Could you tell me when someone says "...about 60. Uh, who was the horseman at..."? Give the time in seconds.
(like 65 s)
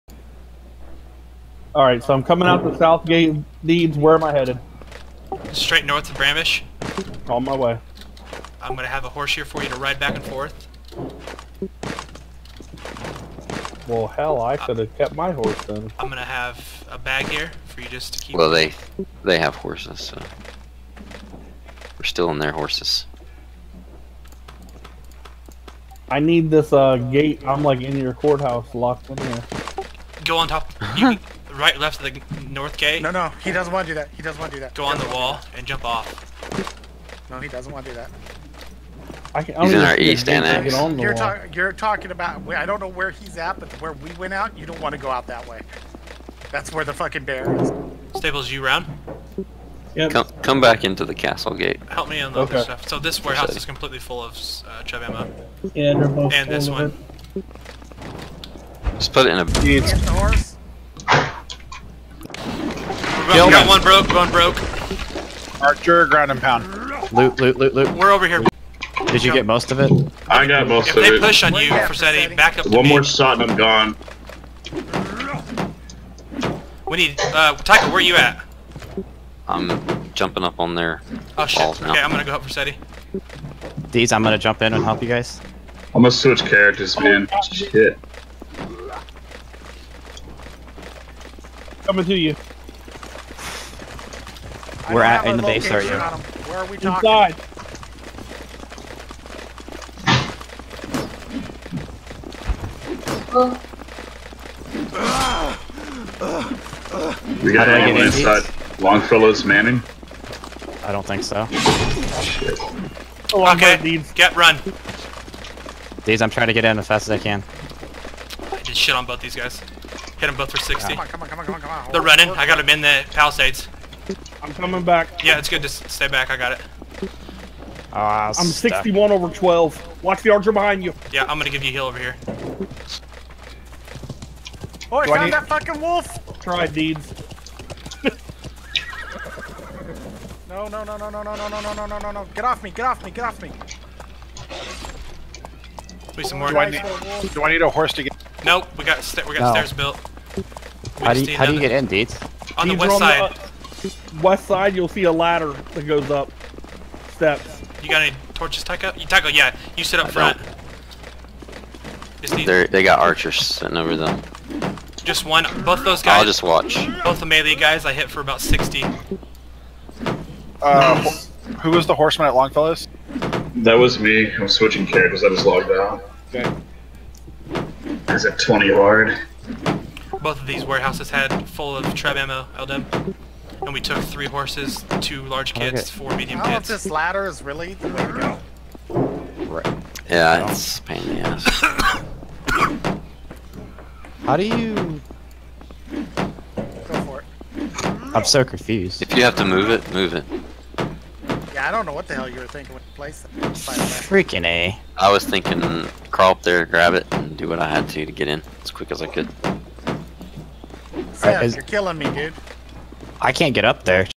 168 s.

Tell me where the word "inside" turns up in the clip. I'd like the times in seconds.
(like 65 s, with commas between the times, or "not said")
97 s, 108 s.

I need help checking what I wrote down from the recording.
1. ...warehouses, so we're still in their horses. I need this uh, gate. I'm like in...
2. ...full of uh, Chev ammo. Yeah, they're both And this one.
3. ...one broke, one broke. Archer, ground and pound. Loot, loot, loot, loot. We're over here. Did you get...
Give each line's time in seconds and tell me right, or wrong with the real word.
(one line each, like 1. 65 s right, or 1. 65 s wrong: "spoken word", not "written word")
1. 19 s wrong: "horses", not "warehouses"
2. 53 s right
3. 63 s right.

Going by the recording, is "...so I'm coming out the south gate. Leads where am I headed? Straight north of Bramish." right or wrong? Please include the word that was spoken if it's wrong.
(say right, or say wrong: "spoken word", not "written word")
right.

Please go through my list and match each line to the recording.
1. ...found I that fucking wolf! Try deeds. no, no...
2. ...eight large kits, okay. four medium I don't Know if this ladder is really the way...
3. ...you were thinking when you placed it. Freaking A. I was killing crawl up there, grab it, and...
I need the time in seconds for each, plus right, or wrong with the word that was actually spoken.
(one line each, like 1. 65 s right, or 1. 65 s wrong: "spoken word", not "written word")
1. 135 s right
2. 185 s wrong: "two", not "eight"
3. 202 s wrong: "thinking", not "killing".